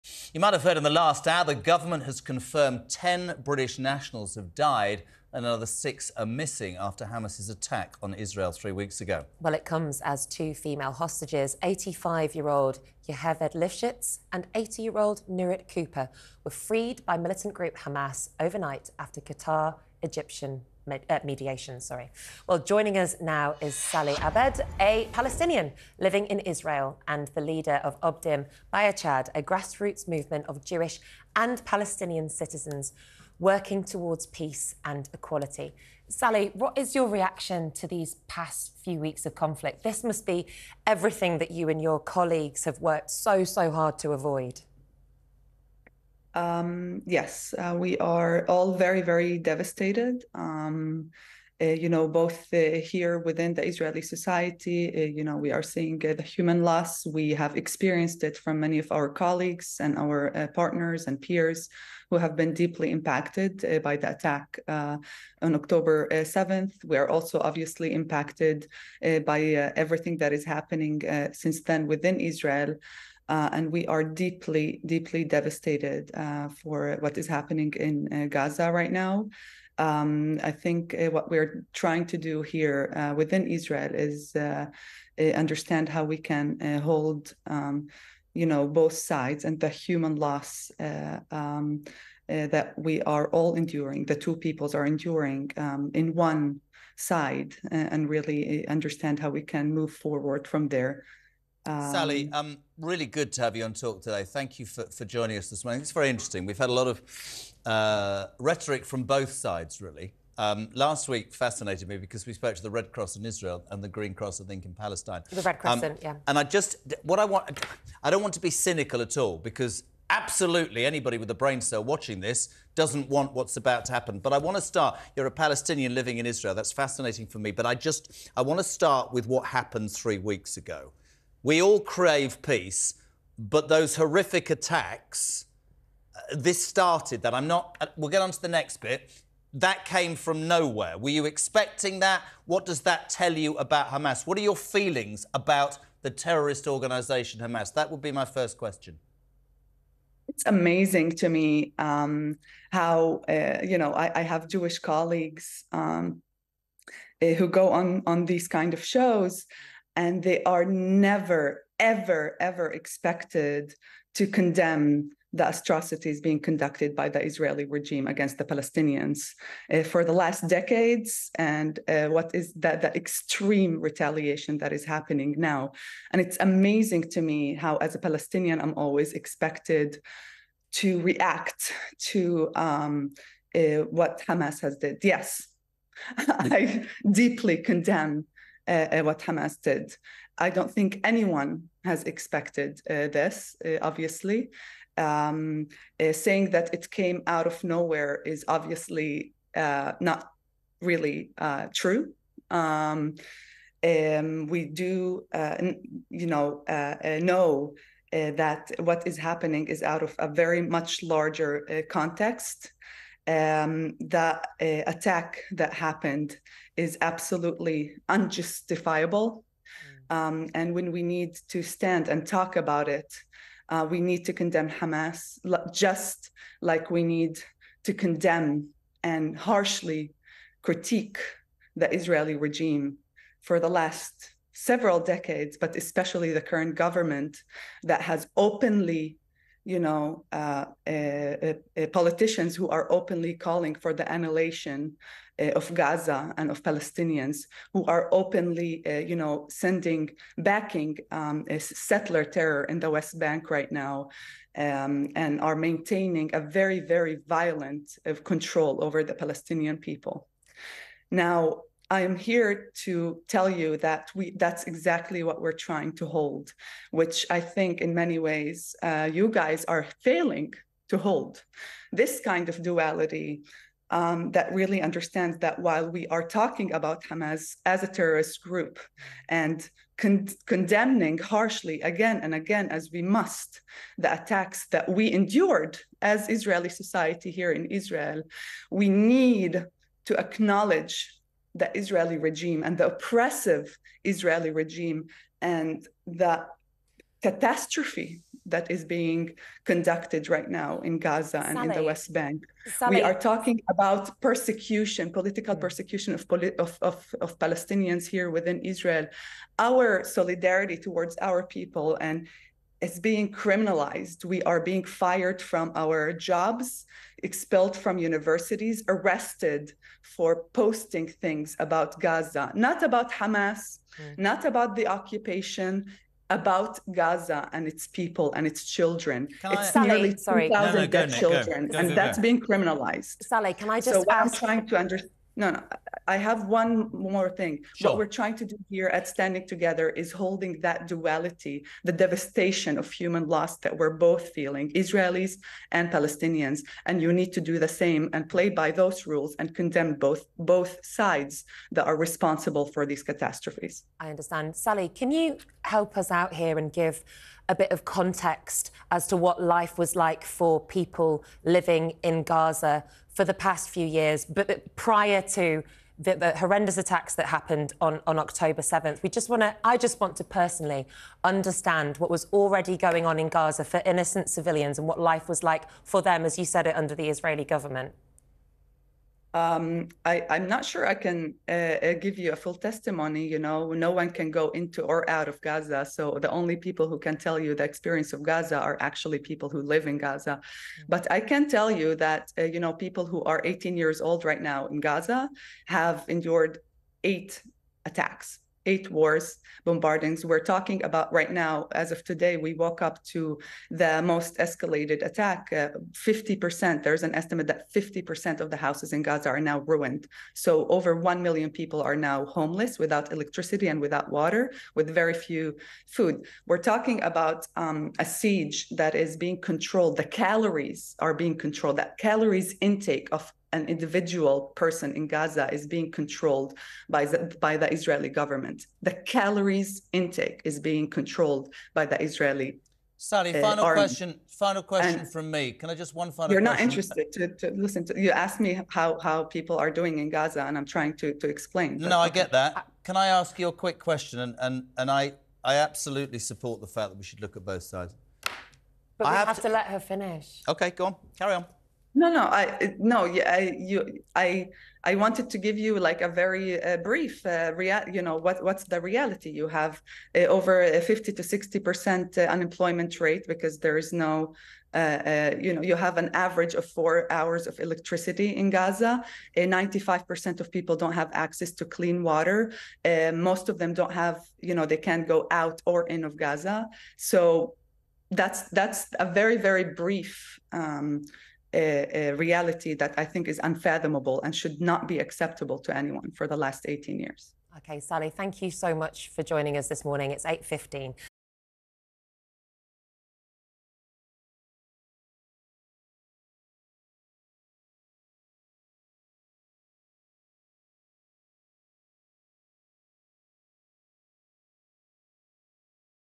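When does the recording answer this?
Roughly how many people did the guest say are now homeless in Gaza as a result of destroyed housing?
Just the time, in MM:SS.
06:50.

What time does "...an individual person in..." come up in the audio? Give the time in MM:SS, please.
07:03.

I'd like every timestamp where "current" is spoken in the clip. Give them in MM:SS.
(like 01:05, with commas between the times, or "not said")
03:56.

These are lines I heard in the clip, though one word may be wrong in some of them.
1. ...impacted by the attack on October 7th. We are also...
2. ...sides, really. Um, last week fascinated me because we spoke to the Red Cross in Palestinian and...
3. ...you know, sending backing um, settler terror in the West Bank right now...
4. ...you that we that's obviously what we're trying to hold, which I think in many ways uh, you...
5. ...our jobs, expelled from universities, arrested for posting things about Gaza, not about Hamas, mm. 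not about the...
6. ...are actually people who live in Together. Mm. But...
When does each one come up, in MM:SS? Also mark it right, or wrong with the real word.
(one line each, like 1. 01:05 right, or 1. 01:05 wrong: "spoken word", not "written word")
1. 01:02 right
2. 01:49 wrong: "Israel", not "Palestinian"
3. 04:08 right
4. 04:23 wrong: "exactly", not "obviously"
5. 05:15 right
6. 06:28 wrong: "Gaza", not "Together".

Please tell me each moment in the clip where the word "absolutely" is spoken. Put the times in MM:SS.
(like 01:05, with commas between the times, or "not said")
02:00, 03:37, 07:25.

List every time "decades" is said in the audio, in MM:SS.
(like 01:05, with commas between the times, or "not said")
02:50, 03:54.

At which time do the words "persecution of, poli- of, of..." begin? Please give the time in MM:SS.
05:05.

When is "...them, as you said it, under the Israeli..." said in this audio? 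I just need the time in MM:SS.
06:16.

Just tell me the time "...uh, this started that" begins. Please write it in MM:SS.
02:16.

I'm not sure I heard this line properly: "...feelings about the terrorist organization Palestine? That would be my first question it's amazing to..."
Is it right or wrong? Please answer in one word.
wrong.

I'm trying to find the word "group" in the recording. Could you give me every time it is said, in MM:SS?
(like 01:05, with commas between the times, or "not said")
00:17, 04:38.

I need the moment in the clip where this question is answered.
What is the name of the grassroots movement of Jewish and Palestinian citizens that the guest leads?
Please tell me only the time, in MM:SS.
00:28.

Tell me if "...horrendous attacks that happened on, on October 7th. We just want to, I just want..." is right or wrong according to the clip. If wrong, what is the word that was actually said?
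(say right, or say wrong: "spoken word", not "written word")
right.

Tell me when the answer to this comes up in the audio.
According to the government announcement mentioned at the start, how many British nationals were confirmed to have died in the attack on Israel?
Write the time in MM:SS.
00:02.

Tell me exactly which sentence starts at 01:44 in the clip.
Thank you for, for joining us this morning.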